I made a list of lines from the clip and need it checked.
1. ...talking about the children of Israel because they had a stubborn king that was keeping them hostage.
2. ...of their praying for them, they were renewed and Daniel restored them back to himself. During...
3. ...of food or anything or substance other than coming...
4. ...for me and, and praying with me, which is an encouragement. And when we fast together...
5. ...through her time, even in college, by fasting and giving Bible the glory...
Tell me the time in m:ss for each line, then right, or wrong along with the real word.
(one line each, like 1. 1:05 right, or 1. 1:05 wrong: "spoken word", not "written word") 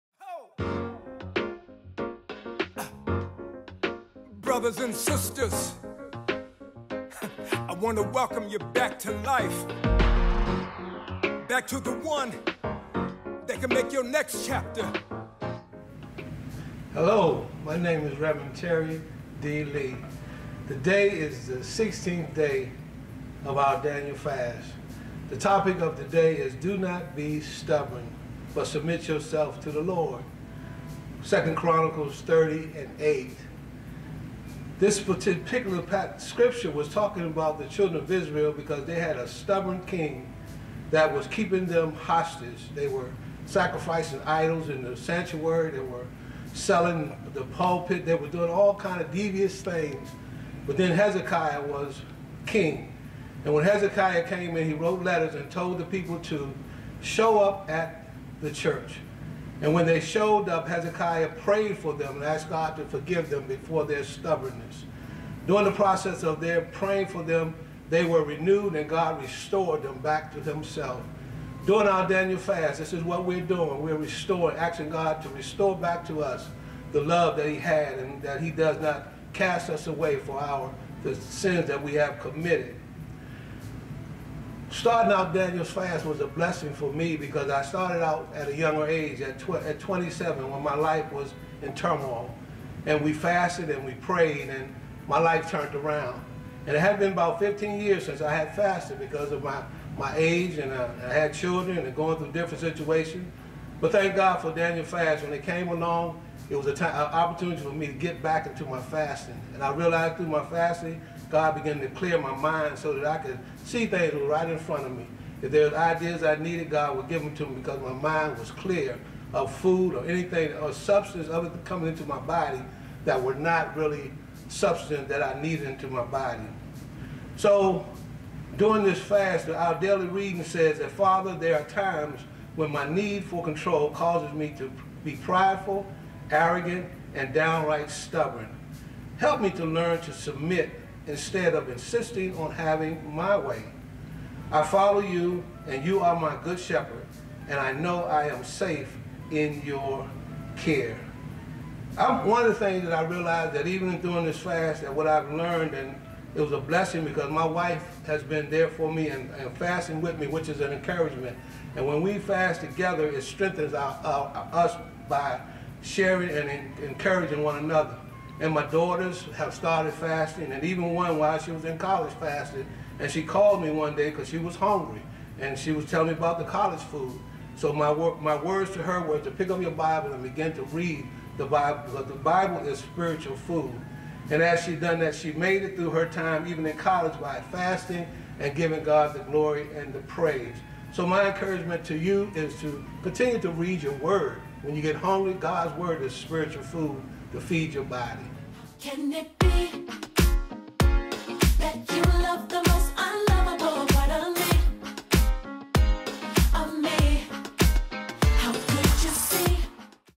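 1. 0:36 right
2. 1:06 wrong: "God", not "Daniel"
3. 1:59 right
4. 2:38 wrong: "fasting", not "praying"
5. 3:05 wrong: "God", not "Bible".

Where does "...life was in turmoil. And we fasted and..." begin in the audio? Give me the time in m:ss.
1:30.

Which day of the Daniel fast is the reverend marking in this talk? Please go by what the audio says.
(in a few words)
16th day.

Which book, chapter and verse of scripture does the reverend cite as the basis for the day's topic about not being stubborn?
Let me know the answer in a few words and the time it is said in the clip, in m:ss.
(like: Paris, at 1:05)
2 Chronicles 30:8, at 0:31.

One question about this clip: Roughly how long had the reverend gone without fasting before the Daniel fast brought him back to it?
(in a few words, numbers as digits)
15 years.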